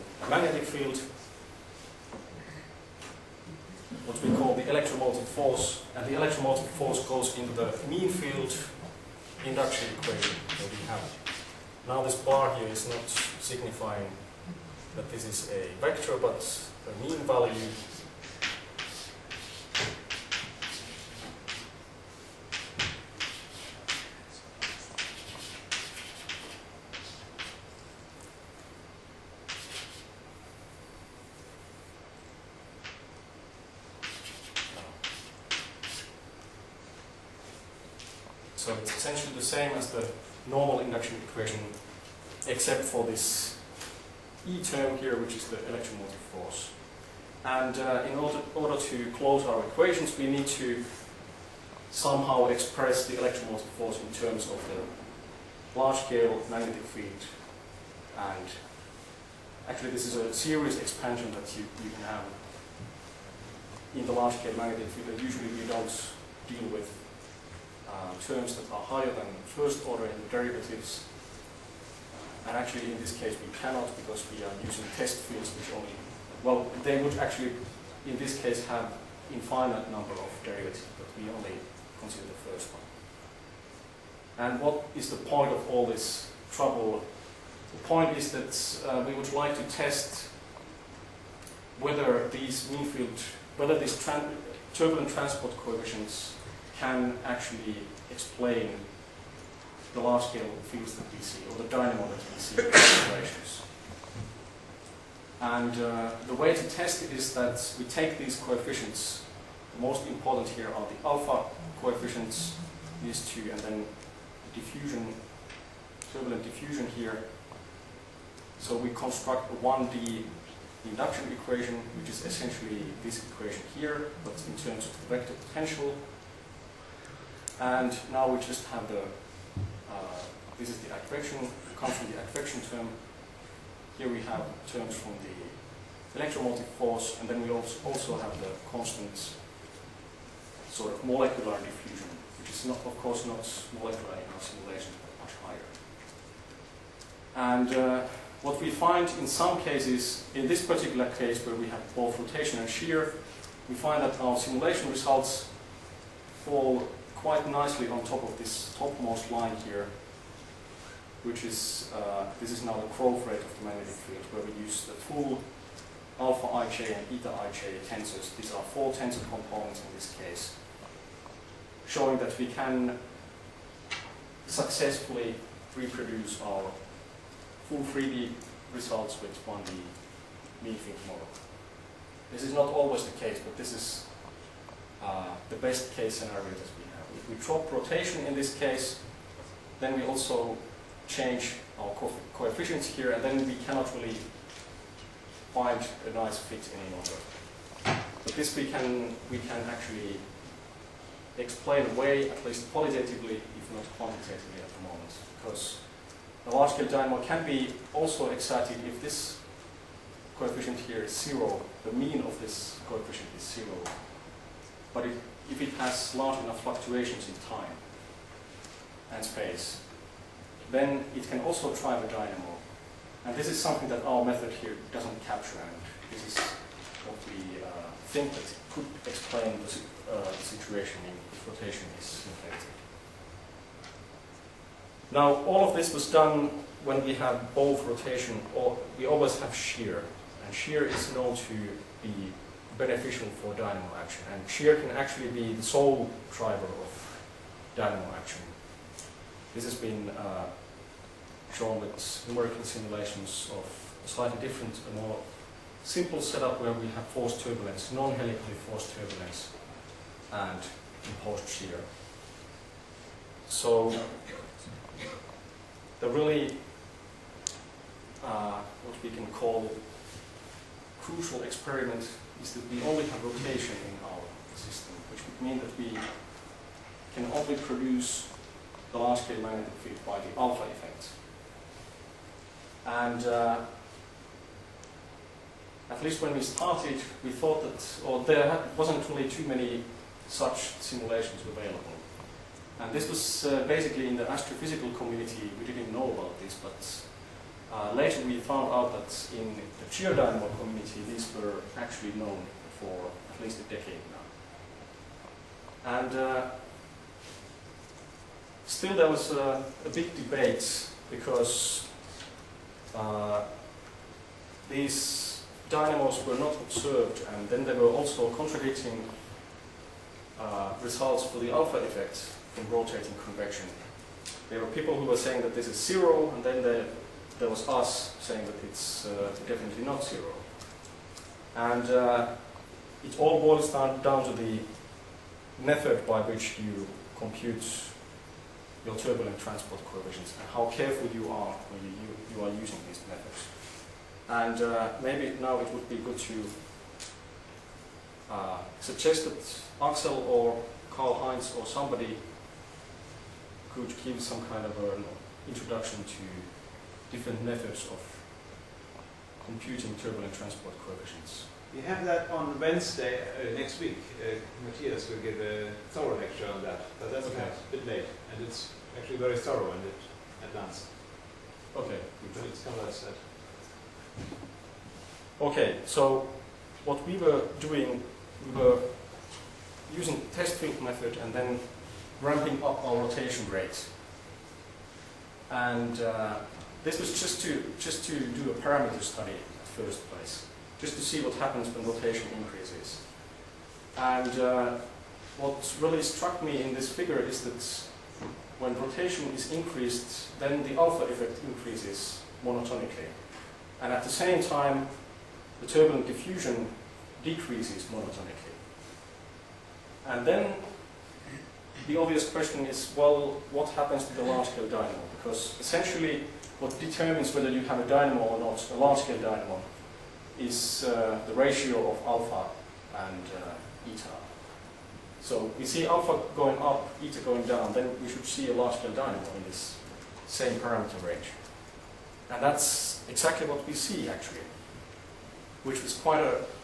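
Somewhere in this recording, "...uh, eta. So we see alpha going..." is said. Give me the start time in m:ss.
7:03.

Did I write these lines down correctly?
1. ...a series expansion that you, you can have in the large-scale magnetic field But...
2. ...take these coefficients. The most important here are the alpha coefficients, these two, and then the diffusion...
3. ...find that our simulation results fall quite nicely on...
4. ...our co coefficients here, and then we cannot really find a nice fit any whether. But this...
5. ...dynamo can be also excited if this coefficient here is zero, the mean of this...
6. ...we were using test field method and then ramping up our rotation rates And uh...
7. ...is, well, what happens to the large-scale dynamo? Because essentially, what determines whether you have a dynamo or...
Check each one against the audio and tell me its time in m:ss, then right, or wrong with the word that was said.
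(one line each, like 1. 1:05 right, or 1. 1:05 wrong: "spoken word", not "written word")
1. 1:00 right
2. 1:47 right
3. 2:33 right
4. 3:11 wrong: "longer", not "whether"
5. 3:26 right
6. 6:18 right
7. 6:52 right.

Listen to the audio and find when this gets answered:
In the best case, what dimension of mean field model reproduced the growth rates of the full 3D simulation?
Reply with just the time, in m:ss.
2:59.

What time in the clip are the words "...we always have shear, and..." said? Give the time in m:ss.
3:58.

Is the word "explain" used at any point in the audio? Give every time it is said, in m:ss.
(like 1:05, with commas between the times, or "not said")
1:38, 3:21, 3:49.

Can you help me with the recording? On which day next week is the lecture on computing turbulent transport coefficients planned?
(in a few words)
Wednesday.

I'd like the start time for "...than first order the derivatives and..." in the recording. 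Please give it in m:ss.
1:09.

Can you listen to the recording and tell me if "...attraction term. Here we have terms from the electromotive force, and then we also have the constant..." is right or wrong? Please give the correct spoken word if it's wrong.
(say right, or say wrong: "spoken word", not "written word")
right.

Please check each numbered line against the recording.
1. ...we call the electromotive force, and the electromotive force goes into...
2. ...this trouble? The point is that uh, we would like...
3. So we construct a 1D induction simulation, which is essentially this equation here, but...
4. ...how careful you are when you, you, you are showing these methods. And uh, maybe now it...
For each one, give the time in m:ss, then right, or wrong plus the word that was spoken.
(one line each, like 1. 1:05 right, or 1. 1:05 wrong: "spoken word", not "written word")
1. 0:04 right
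2. 1:25 right
3. 1:58 wrong: "equation", not "simulation"
4. 5:40 wrong: "using", not "showing".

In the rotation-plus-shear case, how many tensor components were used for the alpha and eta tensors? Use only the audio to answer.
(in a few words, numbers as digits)
4.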